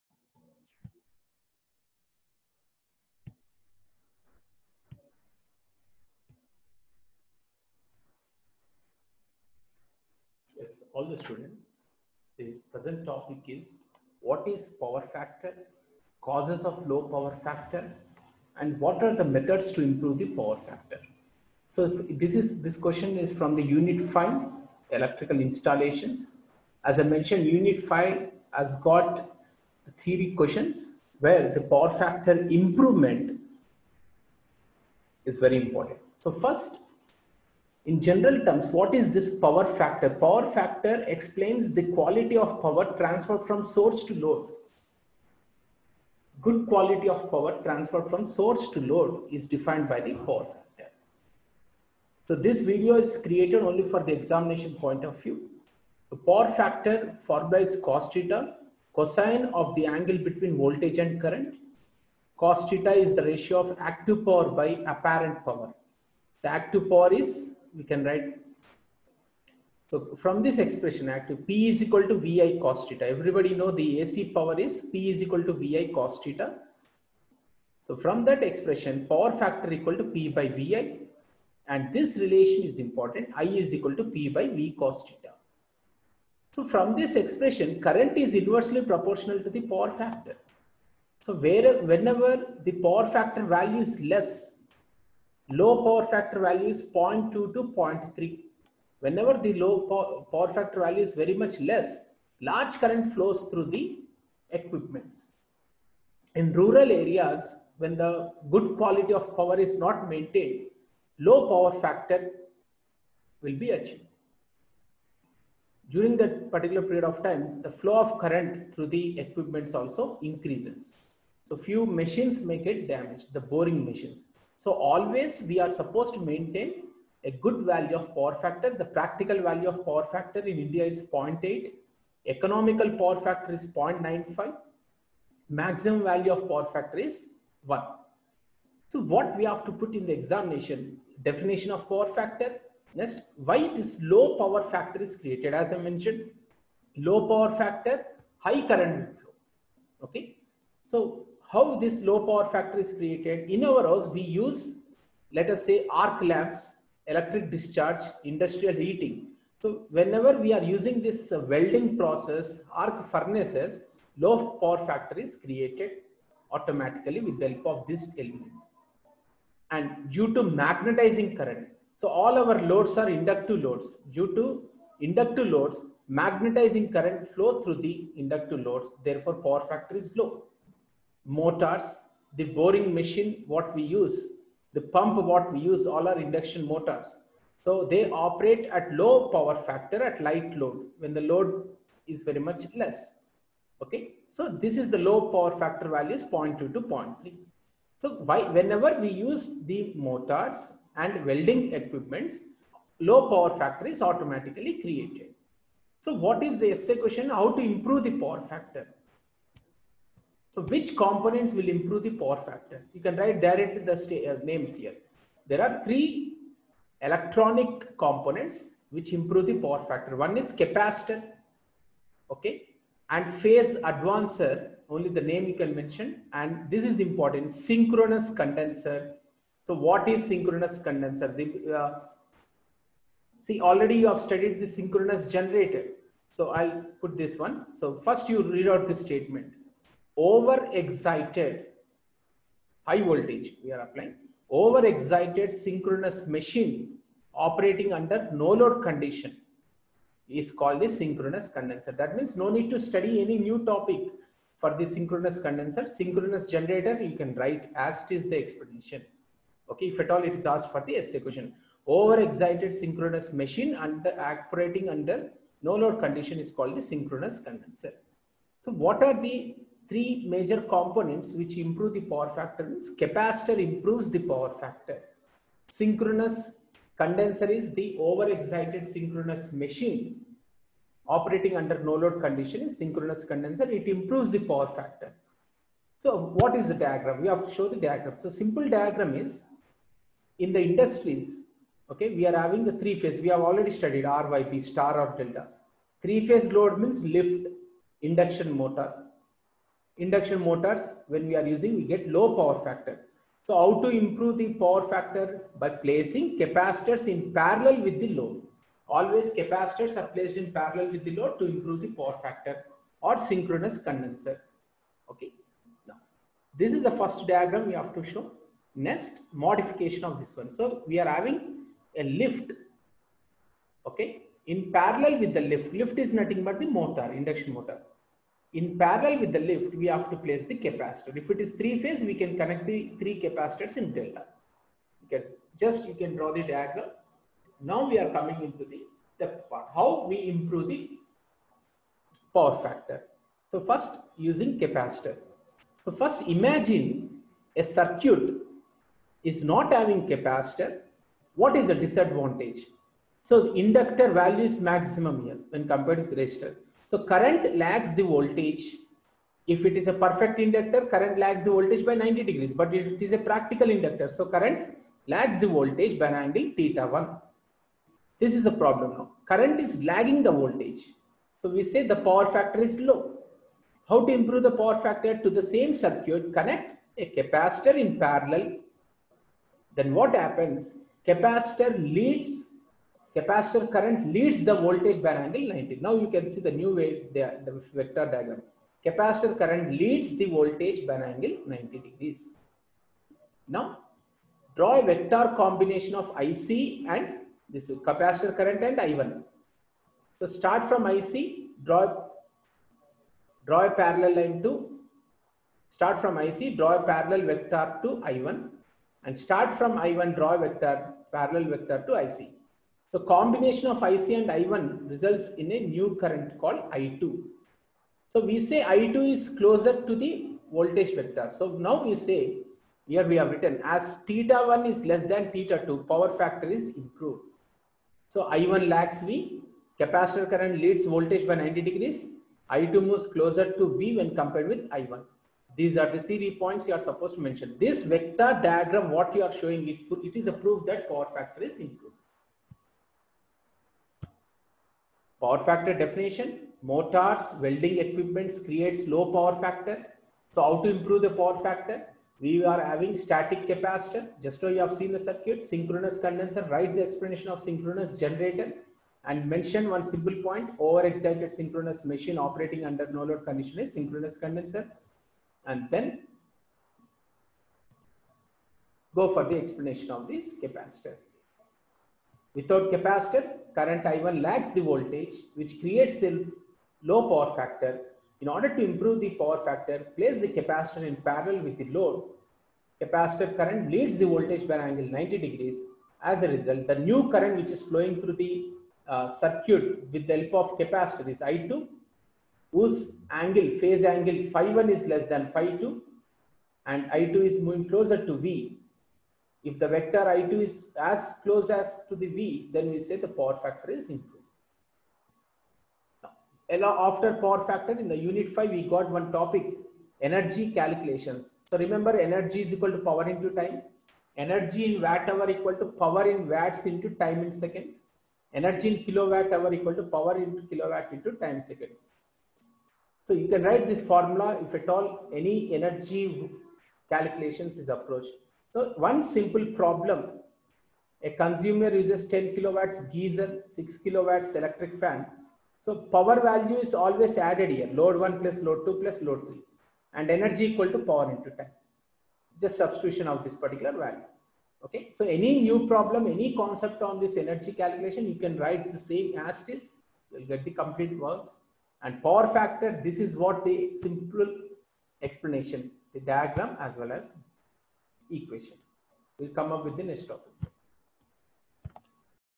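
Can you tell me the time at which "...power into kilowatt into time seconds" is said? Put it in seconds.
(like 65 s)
519 s.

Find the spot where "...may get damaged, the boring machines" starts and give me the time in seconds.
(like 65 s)
122 s.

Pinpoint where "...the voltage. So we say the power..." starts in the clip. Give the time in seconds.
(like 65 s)
370 s.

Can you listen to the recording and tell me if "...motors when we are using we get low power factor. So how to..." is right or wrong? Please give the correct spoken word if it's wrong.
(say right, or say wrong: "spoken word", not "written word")
right.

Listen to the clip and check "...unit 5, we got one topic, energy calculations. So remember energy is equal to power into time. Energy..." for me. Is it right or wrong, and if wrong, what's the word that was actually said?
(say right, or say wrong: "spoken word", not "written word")
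right.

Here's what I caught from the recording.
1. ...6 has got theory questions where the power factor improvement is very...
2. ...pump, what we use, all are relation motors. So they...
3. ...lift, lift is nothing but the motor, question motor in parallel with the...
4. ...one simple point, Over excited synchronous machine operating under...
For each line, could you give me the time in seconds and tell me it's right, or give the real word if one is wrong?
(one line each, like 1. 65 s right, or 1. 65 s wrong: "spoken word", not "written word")
1. 27 s wrong: "5", not "6"
2. 184 s wrong: "induction", not "relation"
3. 325 s wrong: "induction", not "question"
4. 459 s right.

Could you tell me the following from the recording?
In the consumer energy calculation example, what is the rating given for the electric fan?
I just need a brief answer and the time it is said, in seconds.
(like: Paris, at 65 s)
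6 kilowatts, at 533 s.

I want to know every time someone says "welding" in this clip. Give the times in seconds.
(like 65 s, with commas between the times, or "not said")
161 s, 201 s, 447 s.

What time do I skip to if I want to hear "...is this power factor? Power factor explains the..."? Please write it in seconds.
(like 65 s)
38 s.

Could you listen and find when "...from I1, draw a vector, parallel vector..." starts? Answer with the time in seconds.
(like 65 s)
409 s.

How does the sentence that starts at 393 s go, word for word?
Now draw a vector combination of IC and this capacitor current and I1.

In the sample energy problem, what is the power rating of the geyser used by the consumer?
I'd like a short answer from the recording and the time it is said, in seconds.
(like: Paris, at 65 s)
10 kilowatts, at 532 s.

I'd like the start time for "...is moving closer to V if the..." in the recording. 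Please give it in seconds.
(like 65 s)
497 s.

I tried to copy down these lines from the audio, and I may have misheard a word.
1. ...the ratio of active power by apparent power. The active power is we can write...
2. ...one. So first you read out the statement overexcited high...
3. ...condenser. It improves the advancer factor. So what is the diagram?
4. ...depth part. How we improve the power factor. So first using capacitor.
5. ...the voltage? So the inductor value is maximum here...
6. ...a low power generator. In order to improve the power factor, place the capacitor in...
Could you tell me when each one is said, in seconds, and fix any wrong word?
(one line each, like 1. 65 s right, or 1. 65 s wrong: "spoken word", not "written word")
1. 63 s right
2. 237 s right
3. 283 s wrong: "power", not "advancer"
4. 339 s right
5. 351 s wrong: "disadvantage", not "voltage"
6. 476 s wrong: "factor", not "generator".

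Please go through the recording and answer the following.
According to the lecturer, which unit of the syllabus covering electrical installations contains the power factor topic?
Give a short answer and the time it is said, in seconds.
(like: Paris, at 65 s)
Unit 5, at 23 s.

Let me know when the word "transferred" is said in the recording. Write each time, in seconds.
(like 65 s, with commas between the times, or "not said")
42 s, 47 s.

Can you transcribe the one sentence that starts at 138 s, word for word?
So what we have to put in the examination, definition of power factor.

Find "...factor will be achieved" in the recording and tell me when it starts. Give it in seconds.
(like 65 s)
111 s.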